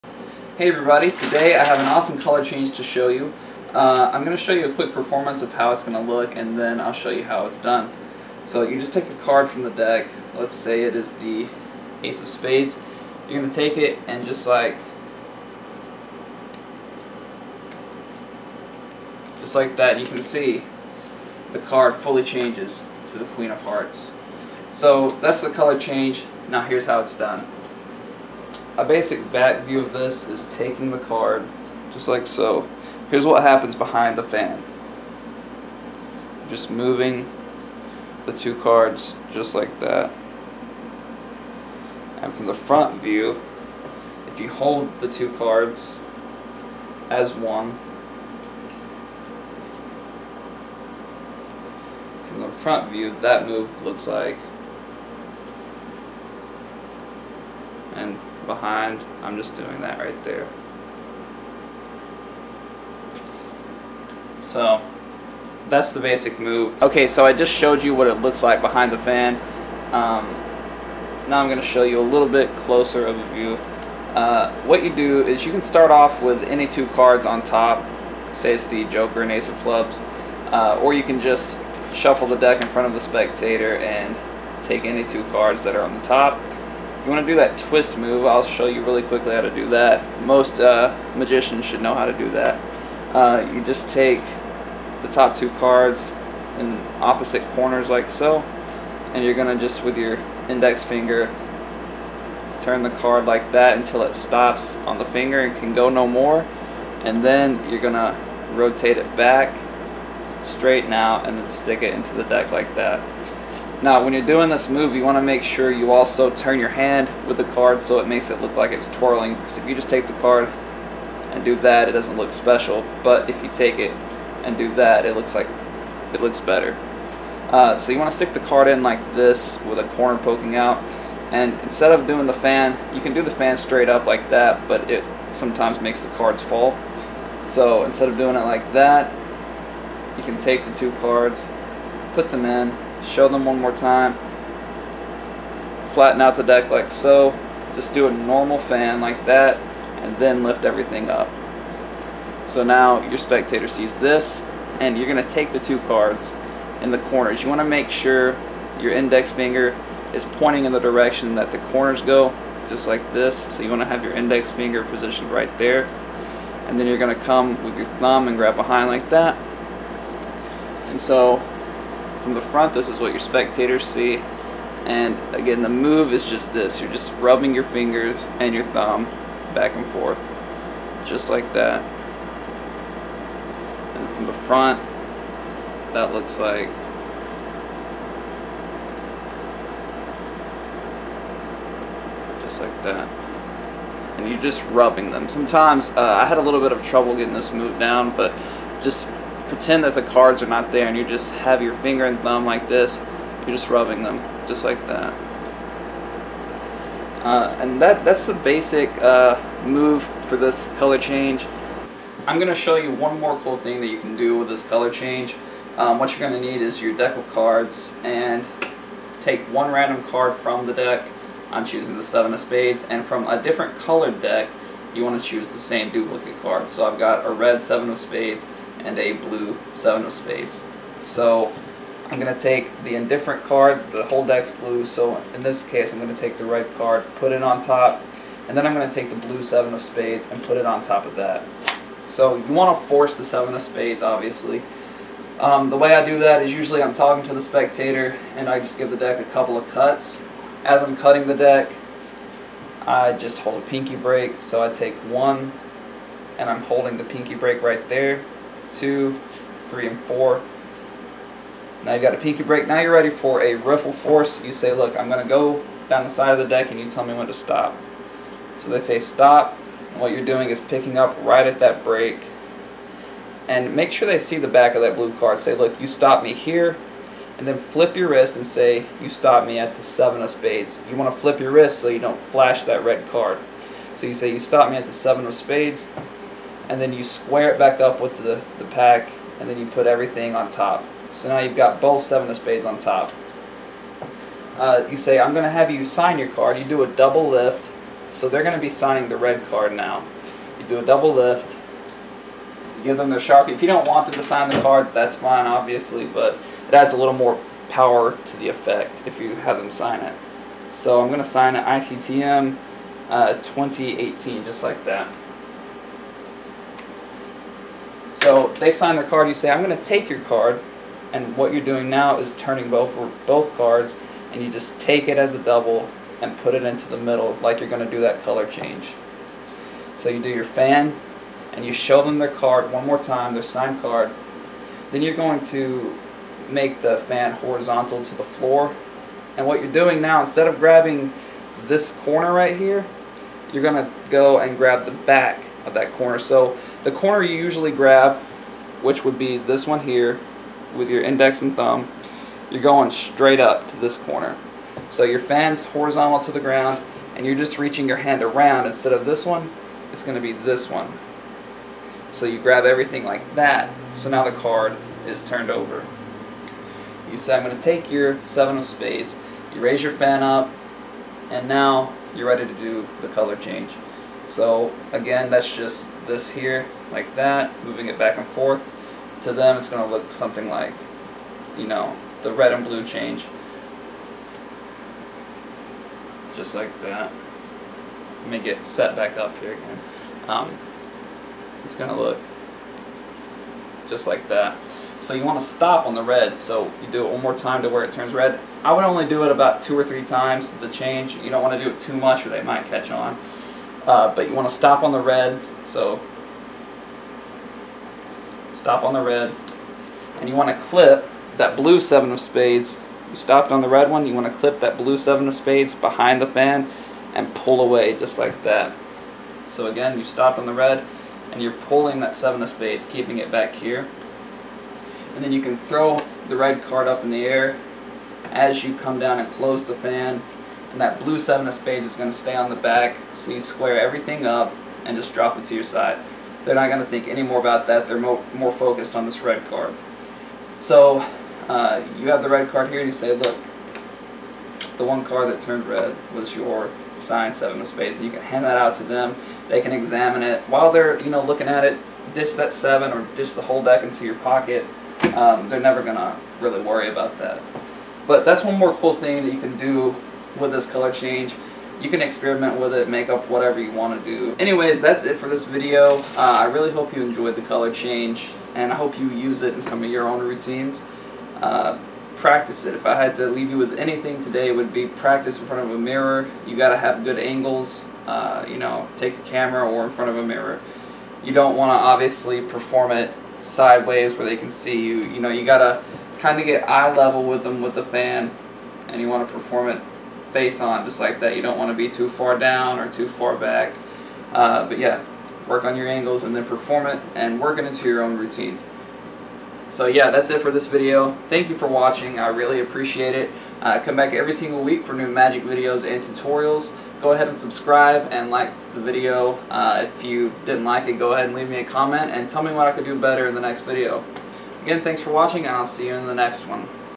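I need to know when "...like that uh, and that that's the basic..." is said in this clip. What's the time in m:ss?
3:24.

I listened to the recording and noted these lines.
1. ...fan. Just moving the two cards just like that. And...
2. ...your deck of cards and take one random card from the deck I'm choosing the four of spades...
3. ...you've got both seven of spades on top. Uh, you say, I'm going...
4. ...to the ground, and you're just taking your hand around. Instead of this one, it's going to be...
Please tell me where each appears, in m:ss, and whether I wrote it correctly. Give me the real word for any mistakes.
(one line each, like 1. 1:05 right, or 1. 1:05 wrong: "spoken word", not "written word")
1. 0:34 right
2. 3:36 wrong: "seven", not "four"
3. 4:51 right
4. 5:56 wrong: "reaching", not "taking".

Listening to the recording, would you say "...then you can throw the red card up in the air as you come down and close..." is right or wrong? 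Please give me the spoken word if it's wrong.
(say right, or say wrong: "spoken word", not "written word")
right.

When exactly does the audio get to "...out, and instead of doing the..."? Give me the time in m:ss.
2:10.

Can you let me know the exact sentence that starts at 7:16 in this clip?
They're not going to think any more about that.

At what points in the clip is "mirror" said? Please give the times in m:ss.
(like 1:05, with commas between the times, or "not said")
7:55, 8:00.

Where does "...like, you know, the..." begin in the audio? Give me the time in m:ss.
6:20.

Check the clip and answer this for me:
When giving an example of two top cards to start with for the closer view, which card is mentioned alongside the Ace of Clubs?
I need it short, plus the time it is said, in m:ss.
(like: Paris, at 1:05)
Joker, at 1:18.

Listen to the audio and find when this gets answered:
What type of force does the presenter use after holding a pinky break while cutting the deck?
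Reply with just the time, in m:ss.
4:23.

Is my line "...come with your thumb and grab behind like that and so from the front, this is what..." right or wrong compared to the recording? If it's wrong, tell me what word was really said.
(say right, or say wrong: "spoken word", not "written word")
right.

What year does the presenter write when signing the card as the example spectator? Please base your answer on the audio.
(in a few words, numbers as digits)
2018.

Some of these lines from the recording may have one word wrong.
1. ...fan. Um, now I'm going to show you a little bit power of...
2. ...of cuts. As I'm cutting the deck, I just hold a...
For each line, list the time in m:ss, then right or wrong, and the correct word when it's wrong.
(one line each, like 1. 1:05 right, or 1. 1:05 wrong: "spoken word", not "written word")
1. 1:08 wrong: "closer", not "power"
2. 4:09 right.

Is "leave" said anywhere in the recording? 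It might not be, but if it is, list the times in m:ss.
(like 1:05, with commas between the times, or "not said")
7:53, 8:31.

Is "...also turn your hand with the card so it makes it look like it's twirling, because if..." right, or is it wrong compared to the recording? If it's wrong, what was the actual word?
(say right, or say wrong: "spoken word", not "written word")
right.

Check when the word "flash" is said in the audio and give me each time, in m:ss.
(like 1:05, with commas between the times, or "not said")
4:42.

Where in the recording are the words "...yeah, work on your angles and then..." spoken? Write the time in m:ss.
8:14.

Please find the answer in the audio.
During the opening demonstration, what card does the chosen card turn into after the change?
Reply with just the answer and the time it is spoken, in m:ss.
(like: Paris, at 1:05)
Queen of Hearts, at 0:23.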